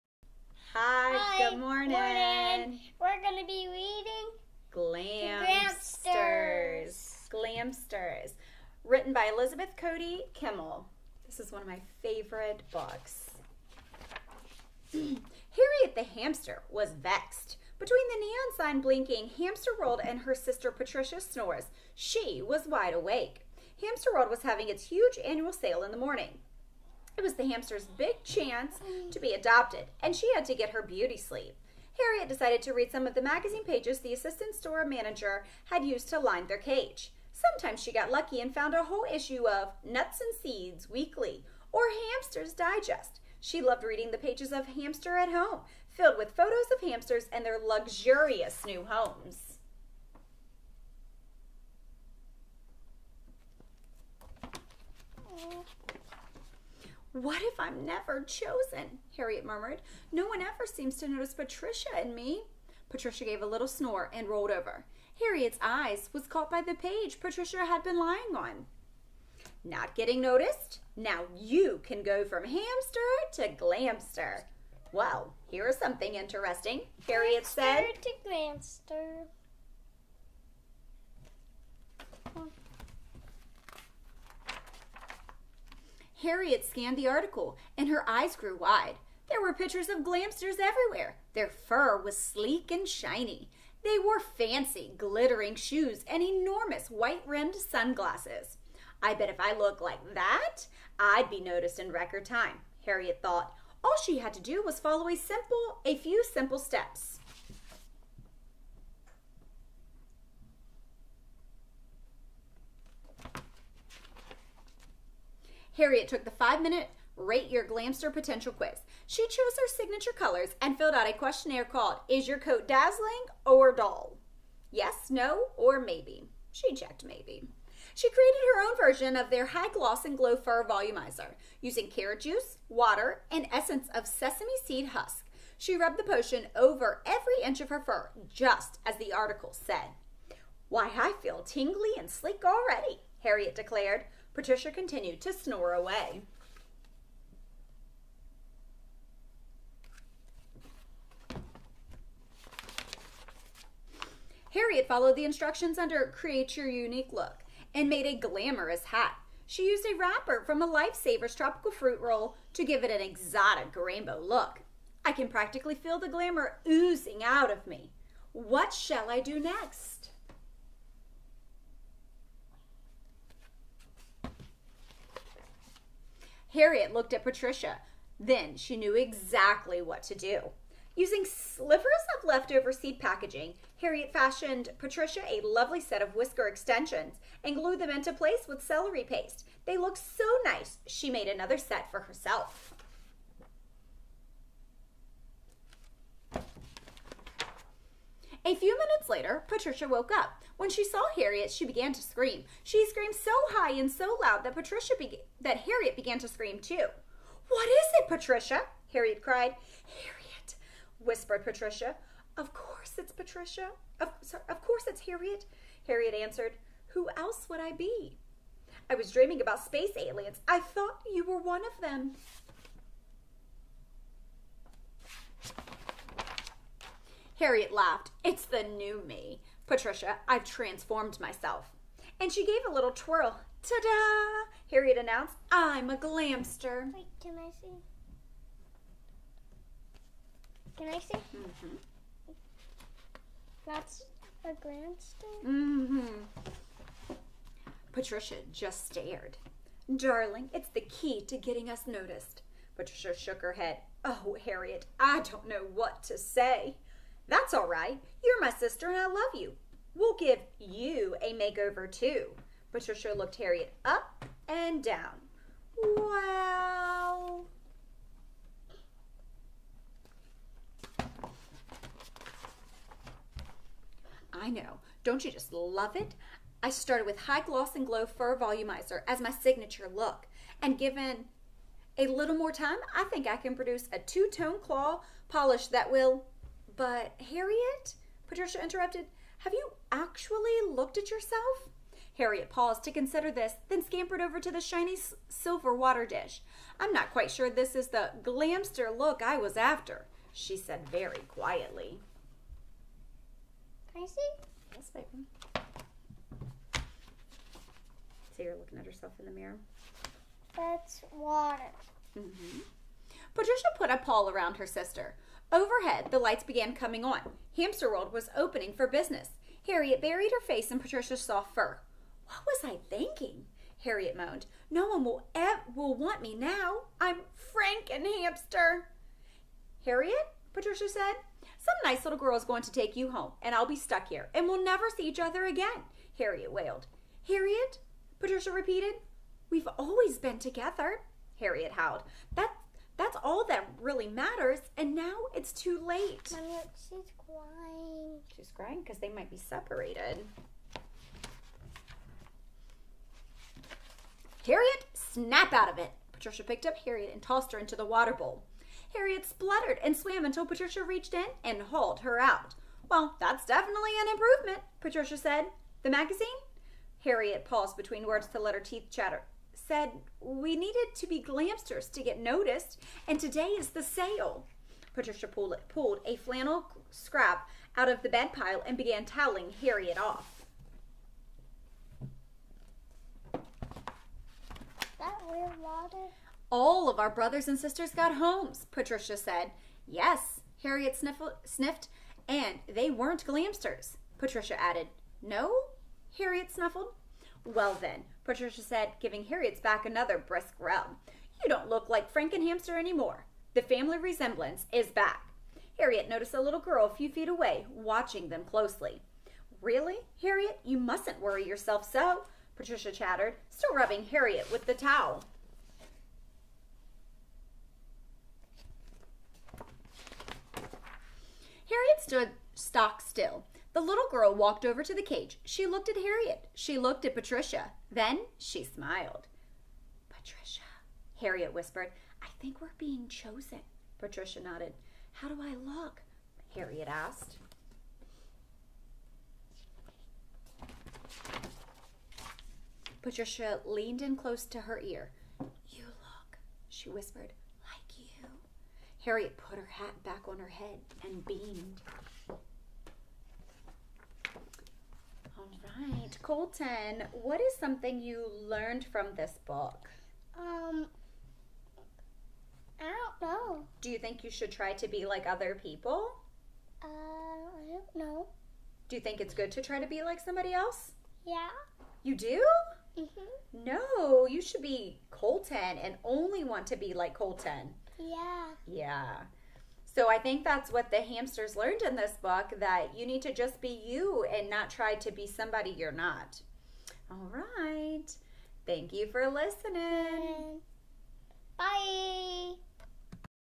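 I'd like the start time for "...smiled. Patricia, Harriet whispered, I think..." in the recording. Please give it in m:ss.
7:08.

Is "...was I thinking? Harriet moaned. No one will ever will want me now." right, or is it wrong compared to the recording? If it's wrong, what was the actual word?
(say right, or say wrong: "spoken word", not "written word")
right.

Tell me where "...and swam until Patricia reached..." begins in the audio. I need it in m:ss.
5:59.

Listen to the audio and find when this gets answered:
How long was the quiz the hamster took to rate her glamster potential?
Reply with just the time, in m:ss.
1:56.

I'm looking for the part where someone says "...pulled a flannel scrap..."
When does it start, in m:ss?
6:15.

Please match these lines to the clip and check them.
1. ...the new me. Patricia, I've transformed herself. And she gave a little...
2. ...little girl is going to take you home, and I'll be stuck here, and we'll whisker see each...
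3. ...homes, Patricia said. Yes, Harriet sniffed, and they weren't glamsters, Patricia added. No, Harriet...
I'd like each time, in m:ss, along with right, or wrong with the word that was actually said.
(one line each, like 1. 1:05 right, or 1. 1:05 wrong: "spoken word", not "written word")
1. 3:48 wrong: "myself", not "herself"
2. 5:32 wrong: "never", not "whisker"
3. 6:28 right.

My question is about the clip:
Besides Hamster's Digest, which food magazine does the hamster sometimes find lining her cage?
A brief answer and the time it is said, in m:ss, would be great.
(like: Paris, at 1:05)
Nuts and Seeds Weekly, at 0:39.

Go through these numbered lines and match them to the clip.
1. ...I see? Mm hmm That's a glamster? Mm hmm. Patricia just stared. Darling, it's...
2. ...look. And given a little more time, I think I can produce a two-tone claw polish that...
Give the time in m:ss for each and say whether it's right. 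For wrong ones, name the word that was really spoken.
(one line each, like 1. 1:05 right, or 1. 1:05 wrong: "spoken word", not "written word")
1. 4:00 right
2. 4:39 right.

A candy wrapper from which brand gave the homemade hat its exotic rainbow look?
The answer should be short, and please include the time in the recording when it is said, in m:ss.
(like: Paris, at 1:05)
Lifesavers, at 2:40.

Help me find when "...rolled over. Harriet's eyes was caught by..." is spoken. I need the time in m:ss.
1:04.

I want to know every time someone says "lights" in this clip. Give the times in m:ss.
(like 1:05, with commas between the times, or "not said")
5:16.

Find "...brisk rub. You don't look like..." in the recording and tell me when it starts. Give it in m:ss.
6:40.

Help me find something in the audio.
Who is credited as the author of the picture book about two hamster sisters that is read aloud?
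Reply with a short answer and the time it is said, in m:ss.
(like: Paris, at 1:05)
Elizabeth Cody Kimmel, at 0:09.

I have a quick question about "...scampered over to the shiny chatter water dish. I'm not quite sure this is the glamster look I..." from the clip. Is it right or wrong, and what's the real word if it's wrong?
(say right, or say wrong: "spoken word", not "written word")
wrong: "silver", not "chatter".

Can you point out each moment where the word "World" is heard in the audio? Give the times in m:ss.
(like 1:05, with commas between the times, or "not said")
0:19, 0:24, 5:17.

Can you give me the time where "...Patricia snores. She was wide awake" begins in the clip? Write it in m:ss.
0:20.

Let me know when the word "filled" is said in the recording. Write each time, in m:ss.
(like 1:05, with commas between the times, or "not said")
0:45, 2:00.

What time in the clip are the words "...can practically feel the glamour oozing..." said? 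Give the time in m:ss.
2:45.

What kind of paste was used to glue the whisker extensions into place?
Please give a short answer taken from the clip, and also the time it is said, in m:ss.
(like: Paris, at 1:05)
Celery paste, at 3:08.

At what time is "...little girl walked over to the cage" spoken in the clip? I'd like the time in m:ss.
7:03.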